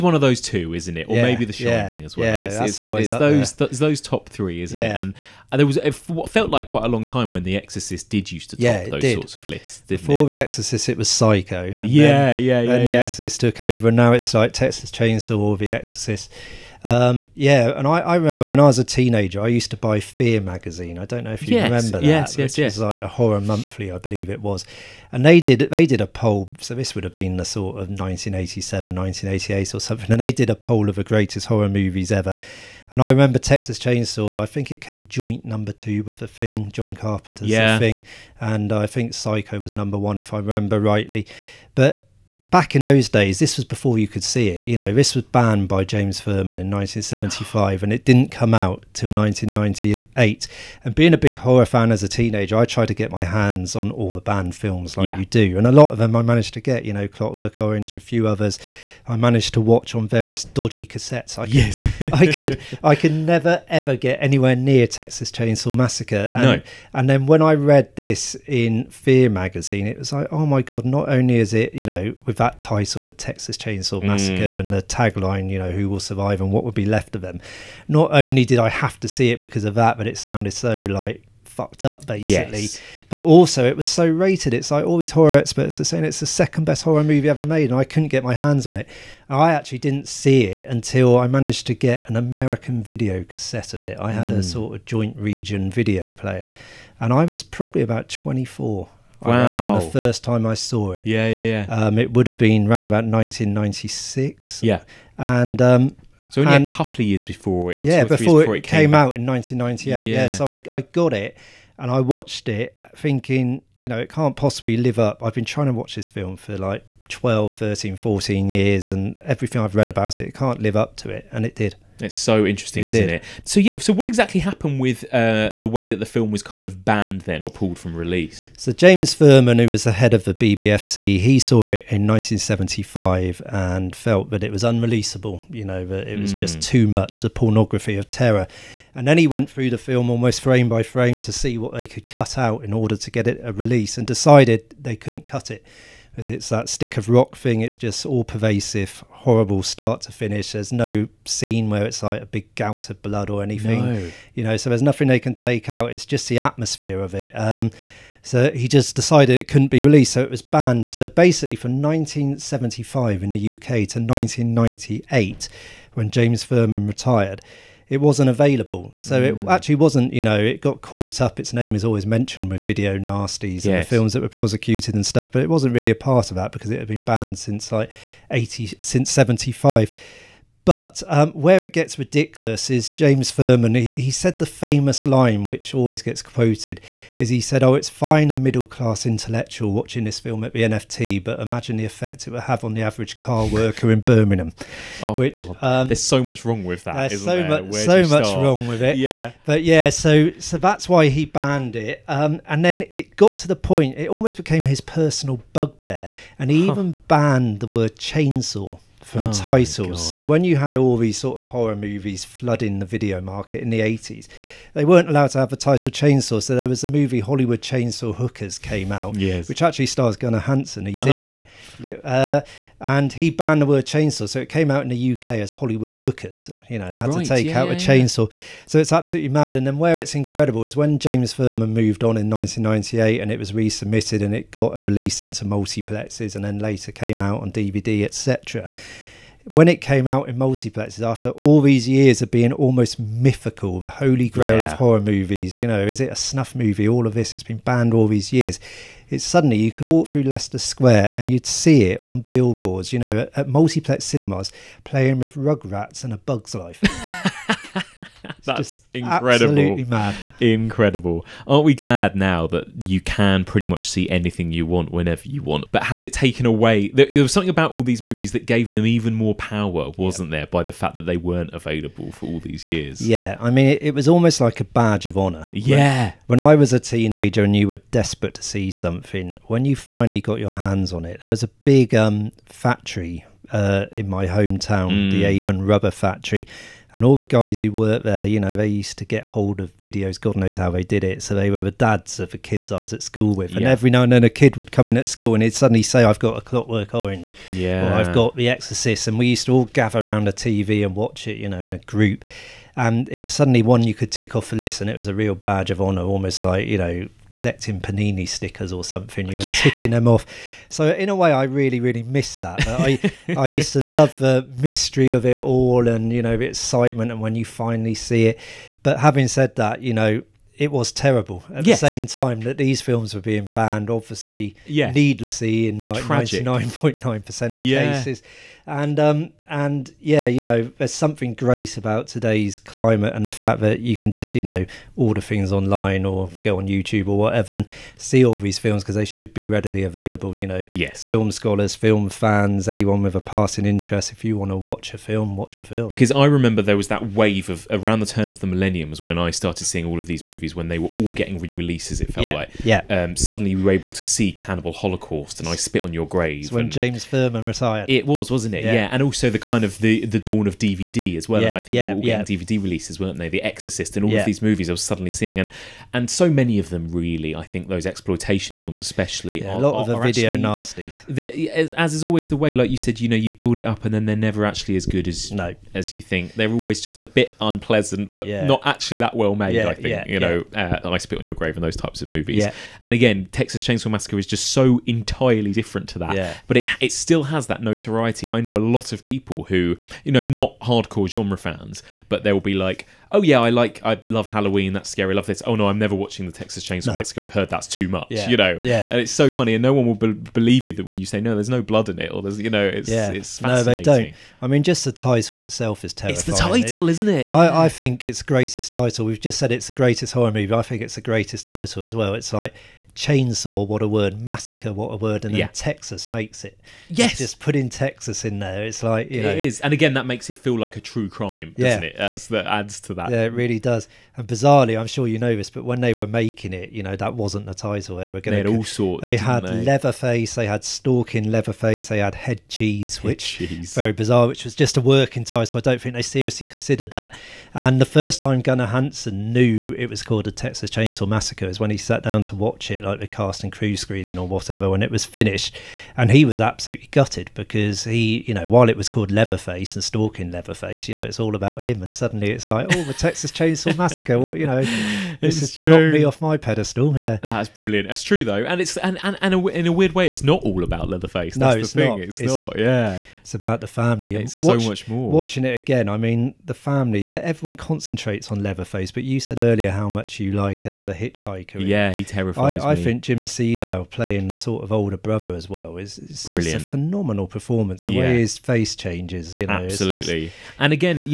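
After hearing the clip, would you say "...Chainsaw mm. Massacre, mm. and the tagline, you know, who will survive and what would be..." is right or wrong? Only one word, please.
right.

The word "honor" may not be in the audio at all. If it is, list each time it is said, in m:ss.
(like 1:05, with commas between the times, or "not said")
4:35, 5:05.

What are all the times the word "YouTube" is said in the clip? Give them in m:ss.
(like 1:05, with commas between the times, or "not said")
5:36.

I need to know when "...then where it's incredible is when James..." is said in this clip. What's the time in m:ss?
3:49.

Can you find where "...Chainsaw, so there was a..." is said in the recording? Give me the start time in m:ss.
3:35.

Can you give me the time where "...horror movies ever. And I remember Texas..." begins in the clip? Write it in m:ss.
0:31.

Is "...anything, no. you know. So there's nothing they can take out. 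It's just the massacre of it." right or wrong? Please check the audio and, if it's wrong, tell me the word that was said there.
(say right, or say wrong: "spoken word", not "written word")
wrong: "atmosphere", not "massacre".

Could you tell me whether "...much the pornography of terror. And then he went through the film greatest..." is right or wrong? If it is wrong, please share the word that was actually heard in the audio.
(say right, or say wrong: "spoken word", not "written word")
wrong: "almost", not "greatest".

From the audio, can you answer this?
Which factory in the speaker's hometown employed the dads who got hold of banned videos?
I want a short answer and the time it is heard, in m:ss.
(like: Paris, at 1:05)
Avon Rubber Factory, at 4:45.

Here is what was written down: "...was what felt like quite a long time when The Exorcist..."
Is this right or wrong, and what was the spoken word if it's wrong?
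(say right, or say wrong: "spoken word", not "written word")
right.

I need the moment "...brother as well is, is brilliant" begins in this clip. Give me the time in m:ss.
7:54.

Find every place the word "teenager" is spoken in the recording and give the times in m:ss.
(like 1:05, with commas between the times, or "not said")
0:18, 0:52, 4:36.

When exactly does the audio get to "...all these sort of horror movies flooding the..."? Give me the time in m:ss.
3:30.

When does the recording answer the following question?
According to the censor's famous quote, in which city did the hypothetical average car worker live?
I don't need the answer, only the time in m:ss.
3:14.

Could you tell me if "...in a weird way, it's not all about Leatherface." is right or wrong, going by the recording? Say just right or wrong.
right.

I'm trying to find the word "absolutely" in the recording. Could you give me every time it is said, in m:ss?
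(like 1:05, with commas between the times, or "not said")
3:48, 7:26, 7:59.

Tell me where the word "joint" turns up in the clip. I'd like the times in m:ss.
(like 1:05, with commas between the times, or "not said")
0:35, 1:34.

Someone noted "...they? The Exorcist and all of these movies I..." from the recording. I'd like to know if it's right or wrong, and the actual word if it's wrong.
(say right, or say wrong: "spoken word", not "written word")
right.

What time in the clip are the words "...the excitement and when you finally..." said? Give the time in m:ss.
5:16.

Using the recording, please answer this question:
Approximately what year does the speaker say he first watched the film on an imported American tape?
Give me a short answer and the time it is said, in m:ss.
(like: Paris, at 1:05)
1996, at 1:43.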